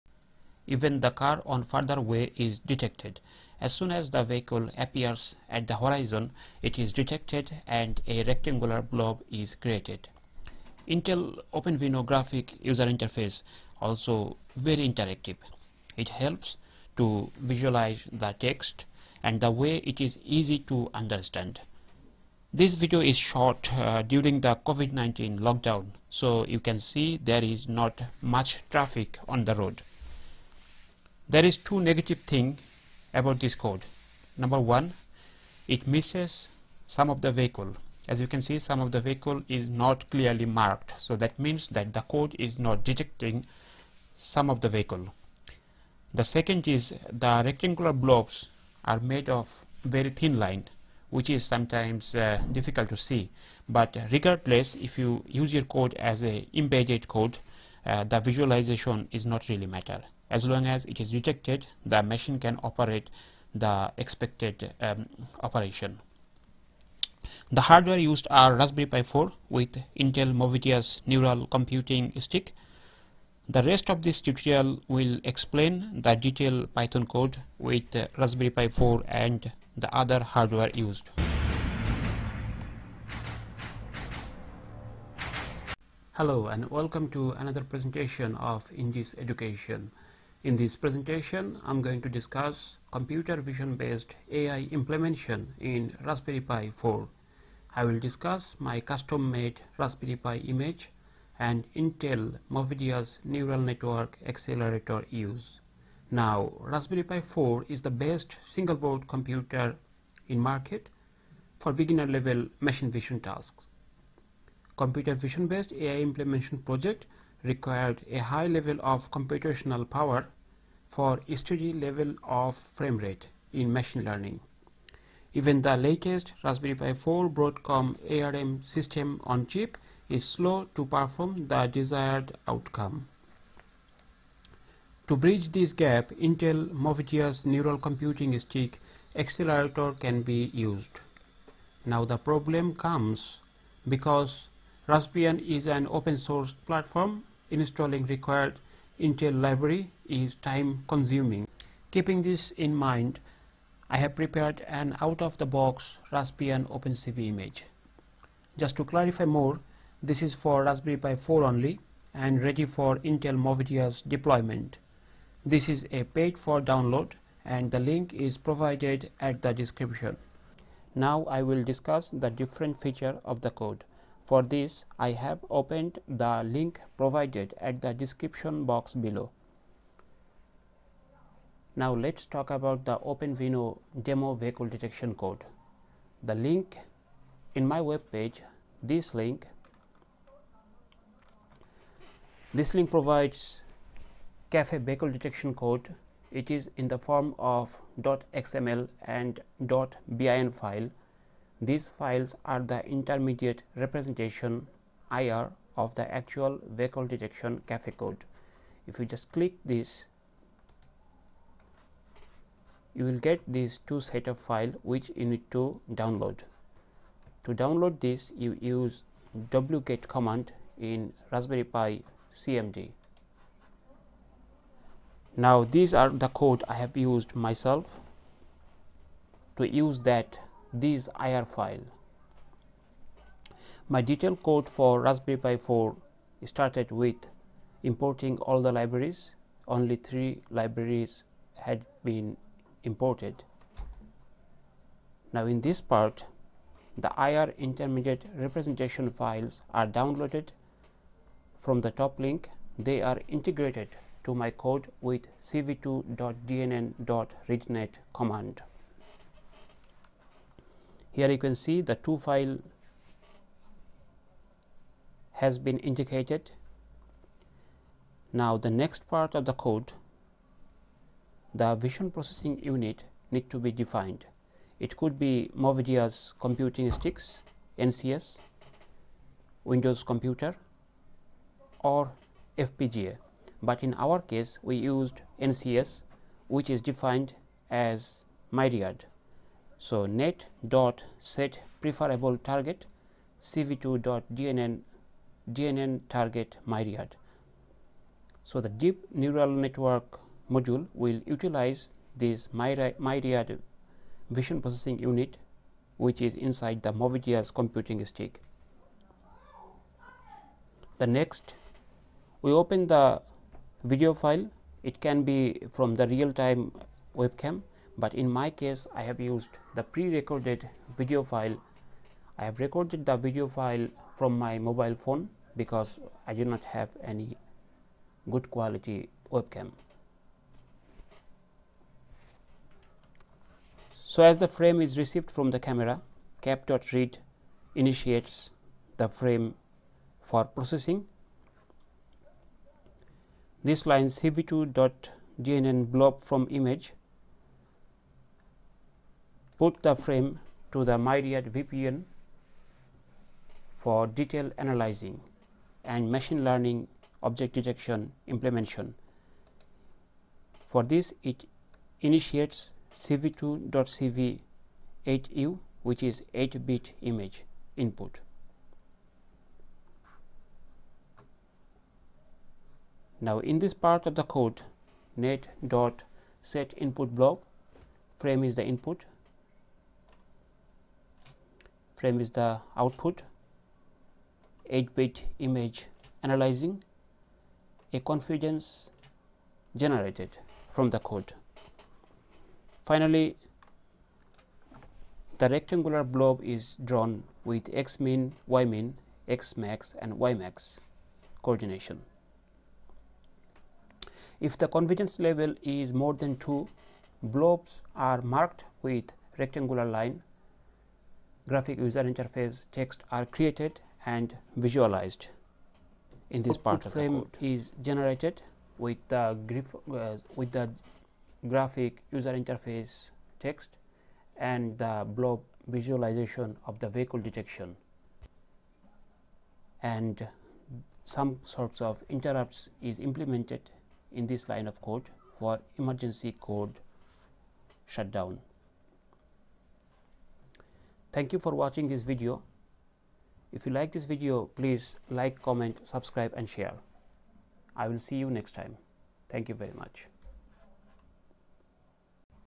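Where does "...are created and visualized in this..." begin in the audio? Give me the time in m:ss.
6:53.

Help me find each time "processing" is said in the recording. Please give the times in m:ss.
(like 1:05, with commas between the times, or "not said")
4:32, 5:04, 5:40.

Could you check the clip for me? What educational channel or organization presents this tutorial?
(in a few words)
Indice Education.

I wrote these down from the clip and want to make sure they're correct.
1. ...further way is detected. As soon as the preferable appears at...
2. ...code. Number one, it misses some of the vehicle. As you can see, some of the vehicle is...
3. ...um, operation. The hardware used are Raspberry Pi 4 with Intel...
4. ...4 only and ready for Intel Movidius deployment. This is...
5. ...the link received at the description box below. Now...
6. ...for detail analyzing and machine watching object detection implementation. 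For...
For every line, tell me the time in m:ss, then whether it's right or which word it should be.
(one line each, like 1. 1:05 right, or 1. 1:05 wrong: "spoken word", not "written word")
1. 0:01 wrong: "vehicle", not "preferable"
2. 0:33 right
3. 1:04 right
4. 2:41 right
5. 2:56 wrong: "provided", not "received"
6. 5:53 wrong: "learning", not "watching".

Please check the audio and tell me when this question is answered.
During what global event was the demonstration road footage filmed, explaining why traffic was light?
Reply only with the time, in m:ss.
0:24.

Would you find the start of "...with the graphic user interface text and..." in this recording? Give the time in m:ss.
7:00.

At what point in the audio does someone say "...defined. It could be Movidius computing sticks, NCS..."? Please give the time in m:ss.
4:33.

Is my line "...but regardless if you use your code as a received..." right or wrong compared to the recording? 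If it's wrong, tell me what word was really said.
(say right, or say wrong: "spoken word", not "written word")
wrong: "embedded", not "received".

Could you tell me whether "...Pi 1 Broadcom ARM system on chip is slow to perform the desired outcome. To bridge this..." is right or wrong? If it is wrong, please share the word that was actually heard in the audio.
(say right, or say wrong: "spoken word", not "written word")
wrong: "4", not "1".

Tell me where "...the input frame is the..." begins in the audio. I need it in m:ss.
6:18.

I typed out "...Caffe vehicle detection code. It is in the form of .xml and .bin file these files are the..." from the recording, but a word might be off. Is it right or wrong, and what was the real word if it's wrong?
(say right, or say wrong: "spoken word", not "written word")
right.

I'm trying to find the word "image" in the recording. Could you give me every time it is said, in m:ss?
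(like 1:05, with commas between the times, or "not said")
1:40, 2:37, 5:46, 6:07, 6:25.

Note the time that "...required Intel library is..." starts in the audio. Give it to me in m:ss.
2:28.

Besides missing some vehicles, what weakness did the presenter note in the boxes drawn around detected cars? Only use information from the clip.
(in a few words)
very thin line.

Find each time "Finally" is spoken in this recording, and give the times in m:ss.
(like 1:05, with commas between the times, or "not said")
6:32.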